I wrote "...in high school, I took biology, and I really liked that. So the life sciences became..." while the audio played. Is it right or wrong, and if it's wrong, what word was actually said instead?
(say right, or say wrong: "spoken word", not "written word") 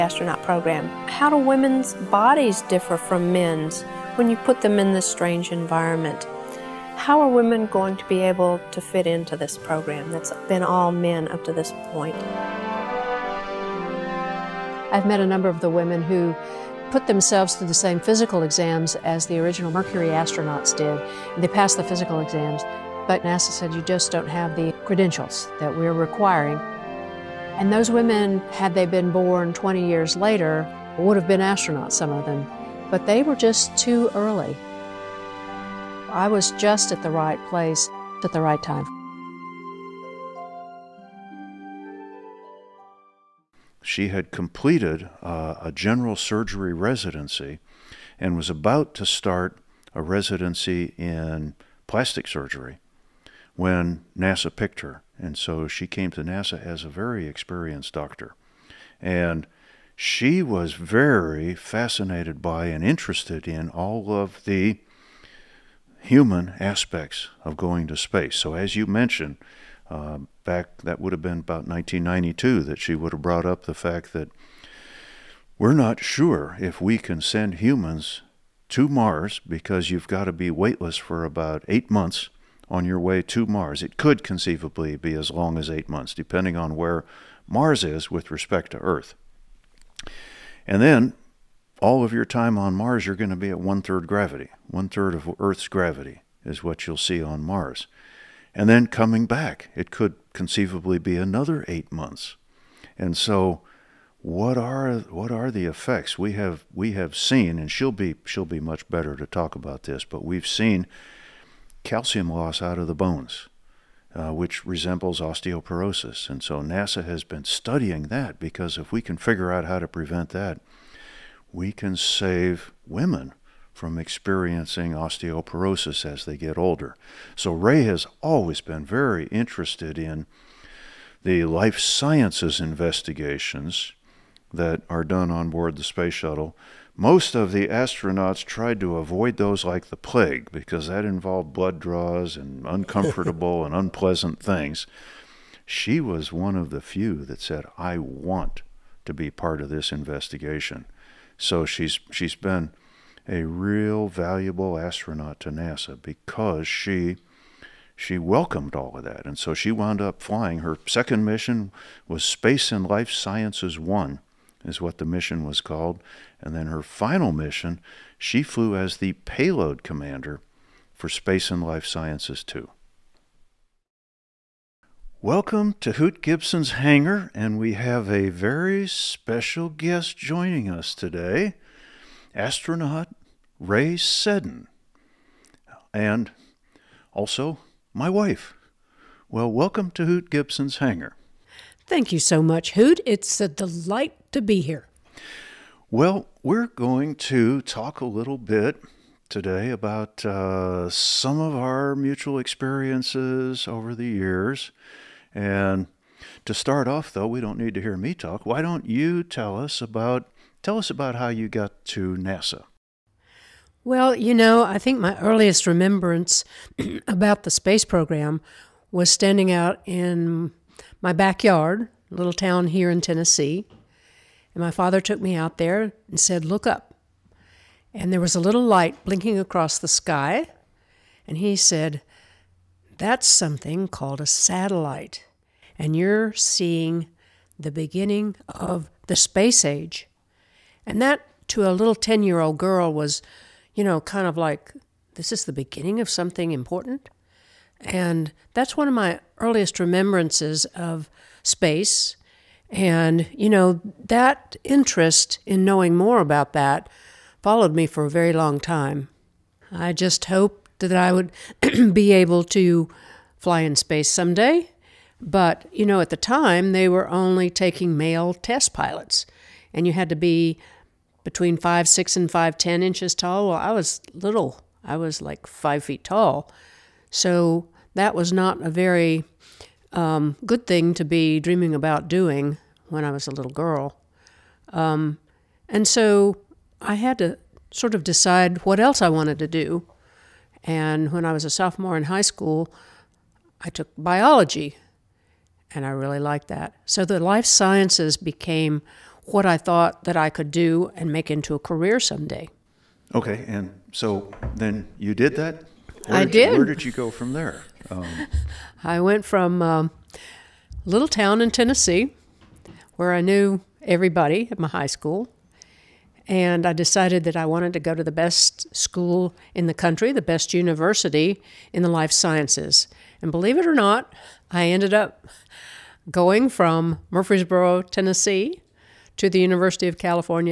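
right.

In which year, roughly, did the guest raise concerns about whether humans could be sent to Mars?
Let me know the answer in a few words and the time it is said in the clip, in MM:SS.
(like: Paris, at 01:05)
1992, at 01:11.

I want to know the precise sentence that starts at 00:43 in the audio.
She had completed uh, a general surgery residency and was about to start a residency in plastic surgery when NASA picked her.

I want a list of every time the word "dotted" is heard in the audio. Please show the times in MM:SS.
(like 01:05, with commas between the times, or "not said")
not said.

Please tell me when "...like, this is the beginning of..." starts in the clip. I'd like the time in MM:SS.
04:04.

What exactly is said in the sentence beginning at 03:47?
And there was a little light blinking across the sky.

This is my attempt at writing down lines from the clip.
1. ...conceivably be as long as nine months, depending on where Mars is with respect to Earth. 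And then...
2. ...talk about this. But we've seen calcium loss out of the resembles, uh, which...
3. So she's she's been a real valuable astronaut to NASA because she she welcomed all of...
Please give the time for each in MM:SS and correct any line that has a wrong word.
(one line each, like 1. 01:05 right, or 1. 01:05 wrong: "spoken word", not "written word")
1. 01:24 wrong: "eight", not "nine"
2. 01:49 wrong: "bones", not "resembles"
3. 02:31 right.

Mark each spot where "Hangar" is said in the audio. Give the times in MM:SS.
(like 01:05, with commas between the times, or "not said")
02:56, 03:10.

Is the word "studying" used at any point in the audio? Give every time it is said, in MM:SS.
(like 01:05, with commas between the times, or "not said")
01:57.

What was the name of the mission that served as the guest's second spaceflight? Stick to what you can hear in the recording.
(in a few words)
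Spacelab Life Sciences 1.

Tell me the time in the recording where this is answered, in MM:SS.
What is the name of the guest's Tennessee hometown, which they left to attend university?
05:27.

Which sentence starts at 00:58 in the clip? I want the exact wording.
And she was very fascinated by and interested in all of the human aspects of going to space.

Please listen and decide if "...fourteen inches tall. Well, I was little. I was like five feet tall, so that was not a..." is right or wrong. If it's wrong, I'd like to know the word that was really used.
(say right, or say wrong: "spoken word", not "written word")
wrong: "ten", not "fourteen".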